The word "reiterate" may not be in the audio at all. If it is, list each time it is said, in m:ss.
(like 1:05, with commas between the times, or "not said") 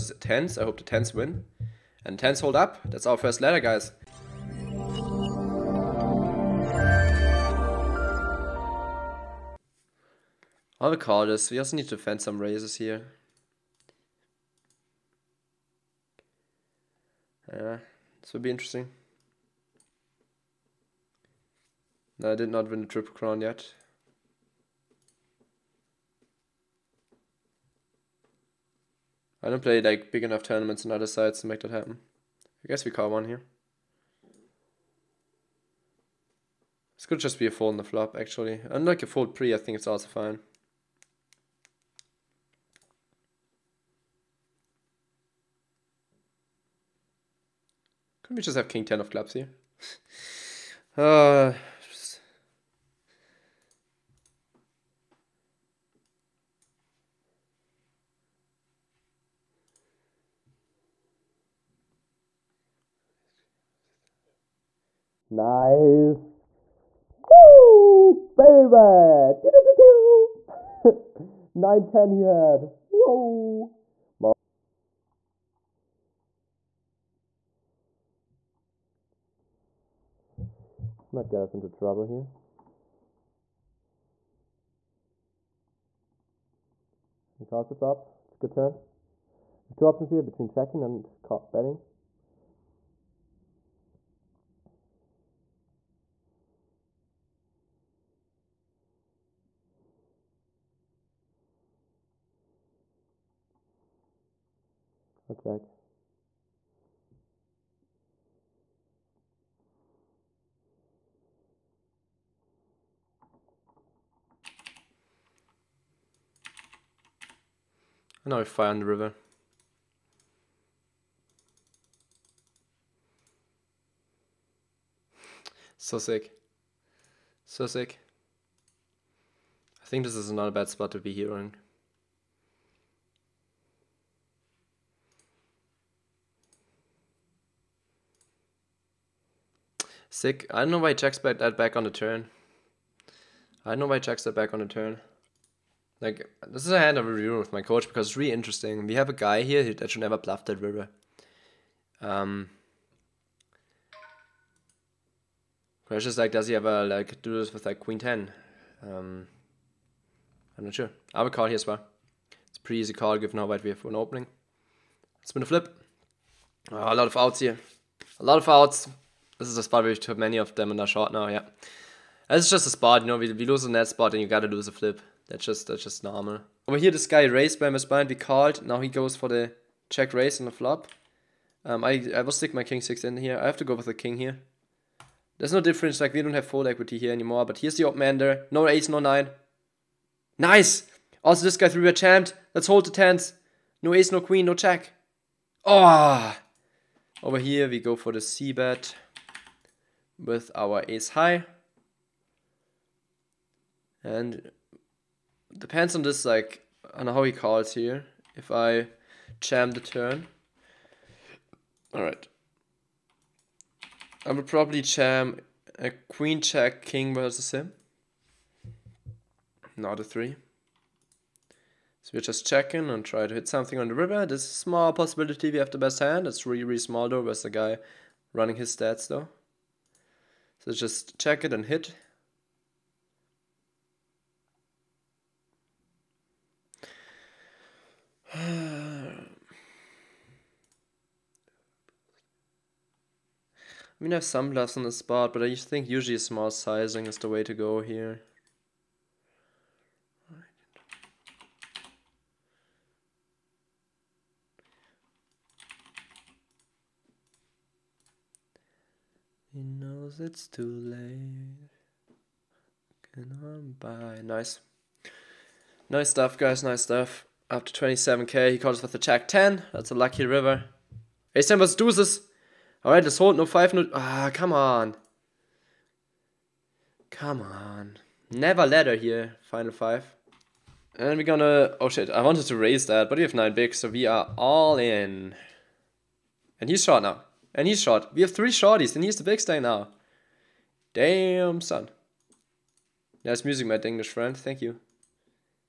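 not said.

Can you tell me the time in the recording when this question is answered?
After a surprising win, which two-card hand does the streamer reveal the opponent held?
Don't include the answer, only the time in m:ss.
1:11.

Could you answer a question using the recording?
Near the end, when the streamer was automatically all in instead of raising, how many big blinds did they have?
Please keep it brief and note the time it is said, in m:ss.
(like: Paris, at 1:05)
9, at 4:43.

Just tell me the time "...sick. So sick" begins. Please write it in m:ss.
2:05.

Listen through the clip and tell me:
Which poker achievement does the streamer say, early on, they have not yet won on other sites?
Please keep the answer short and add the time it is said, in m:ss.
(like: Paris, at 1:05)
triple crown, at 0:22.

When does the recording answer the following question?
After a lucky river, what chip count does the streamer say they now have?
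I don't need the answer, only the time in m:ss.
4:27.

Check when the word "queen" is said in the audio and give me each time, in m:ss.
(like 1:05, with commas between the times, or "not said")
2:37, 3:14, 3:35.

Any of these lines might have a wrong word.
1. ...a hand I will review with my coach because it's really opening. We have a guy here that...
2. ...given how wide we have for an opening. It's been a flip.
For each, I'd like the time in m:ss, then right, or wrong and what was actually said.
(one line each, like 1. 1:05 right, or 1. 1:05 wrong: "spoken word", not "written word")
1. 2:26 wrong: "interesting", not "opening"
2. 2:43 right.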